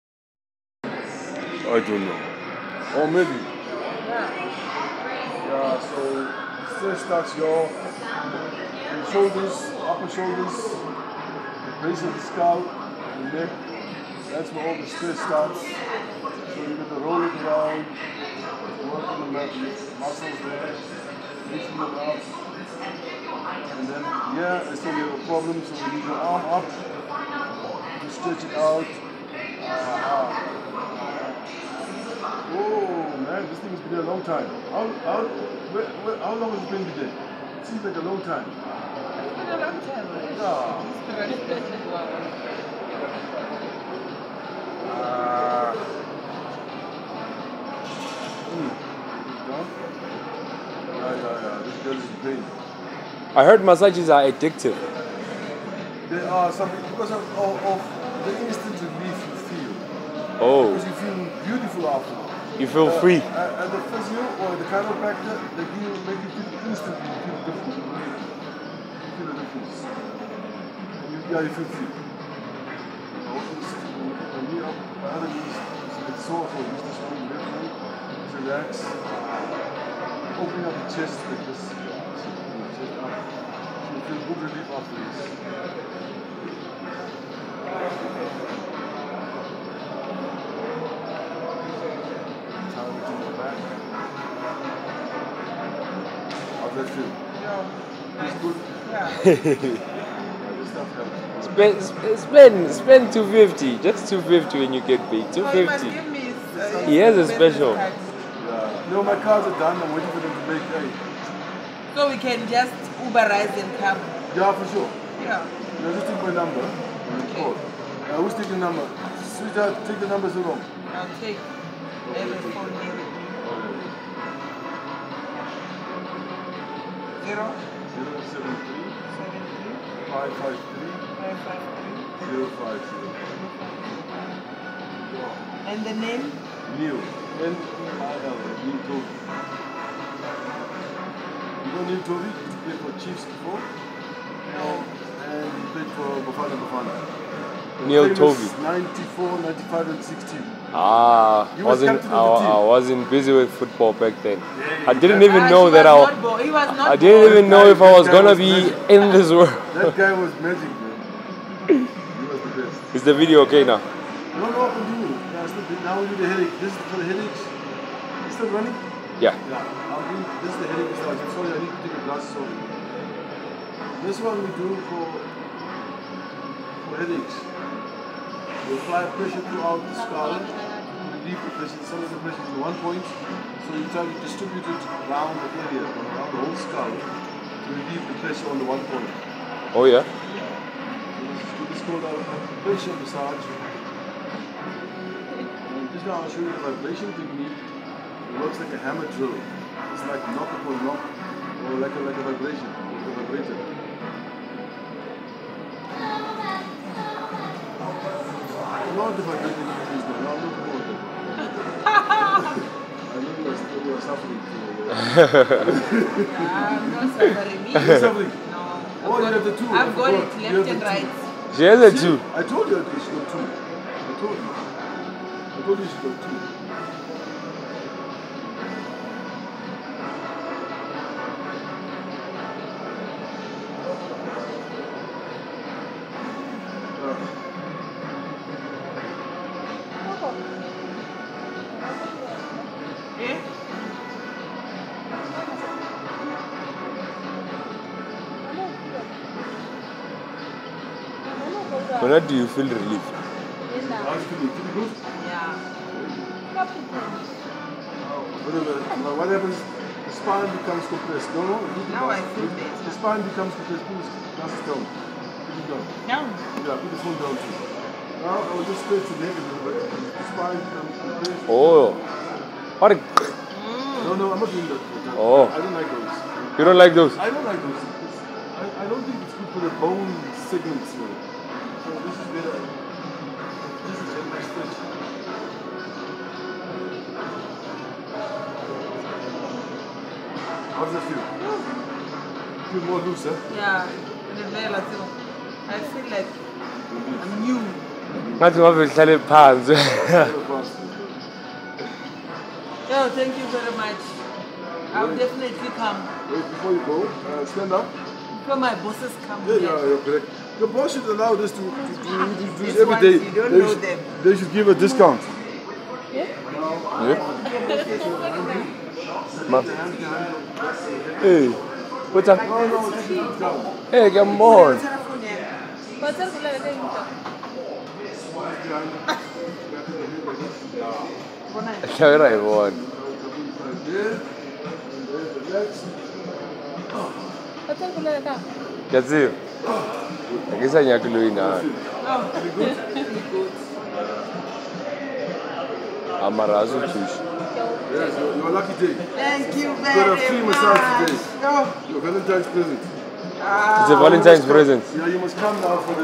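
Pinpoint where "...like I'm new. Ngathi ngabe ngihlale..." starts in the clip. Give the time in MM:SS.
04:56.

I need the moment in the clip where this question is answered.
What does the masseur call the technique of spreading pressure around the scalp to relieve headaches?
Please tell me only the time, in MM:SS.
03:12.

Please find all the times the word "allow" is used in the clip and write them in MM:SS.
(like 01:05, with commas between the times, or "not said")
05:11.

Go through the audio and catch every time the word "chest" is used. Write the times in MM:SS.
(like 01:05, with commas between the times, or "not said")
01:20.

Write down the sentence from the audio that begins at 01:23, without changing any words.
You feel good relief after this.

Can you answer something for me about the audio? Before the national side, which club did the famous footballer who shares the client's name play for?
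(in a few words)
Chiefs.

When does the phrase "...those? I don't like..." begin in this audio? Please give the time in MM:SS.
04:36.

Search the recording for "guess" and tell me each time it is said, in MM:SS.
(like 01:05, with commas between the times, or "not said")
05:40.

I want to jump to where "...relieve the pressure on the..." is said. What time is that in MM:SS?
03:07.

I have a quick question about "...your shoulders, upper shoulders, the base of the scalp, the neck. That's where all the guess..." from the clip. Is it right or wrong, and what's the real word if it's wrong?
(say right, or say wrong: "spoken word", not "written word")
wrong: "stress", not "guess".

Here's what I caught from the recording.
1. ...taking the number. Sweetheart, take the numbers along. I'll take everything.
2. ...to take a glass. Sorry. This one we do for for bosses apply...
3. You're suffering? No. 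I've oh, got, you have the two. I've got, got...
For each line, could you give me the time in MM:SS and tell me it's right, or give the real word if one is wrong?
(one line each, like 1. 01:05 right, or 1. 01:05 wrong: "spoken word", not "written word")
1. 01:58 right
2. 02:51 wrong: "headaches", not "bosses"
3. 03:37 right.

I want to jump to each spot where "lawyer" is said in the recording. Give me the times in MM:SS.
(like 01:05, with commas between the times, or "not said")
not said.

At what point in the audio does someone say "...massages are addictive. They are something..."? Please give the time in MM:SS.
00:53.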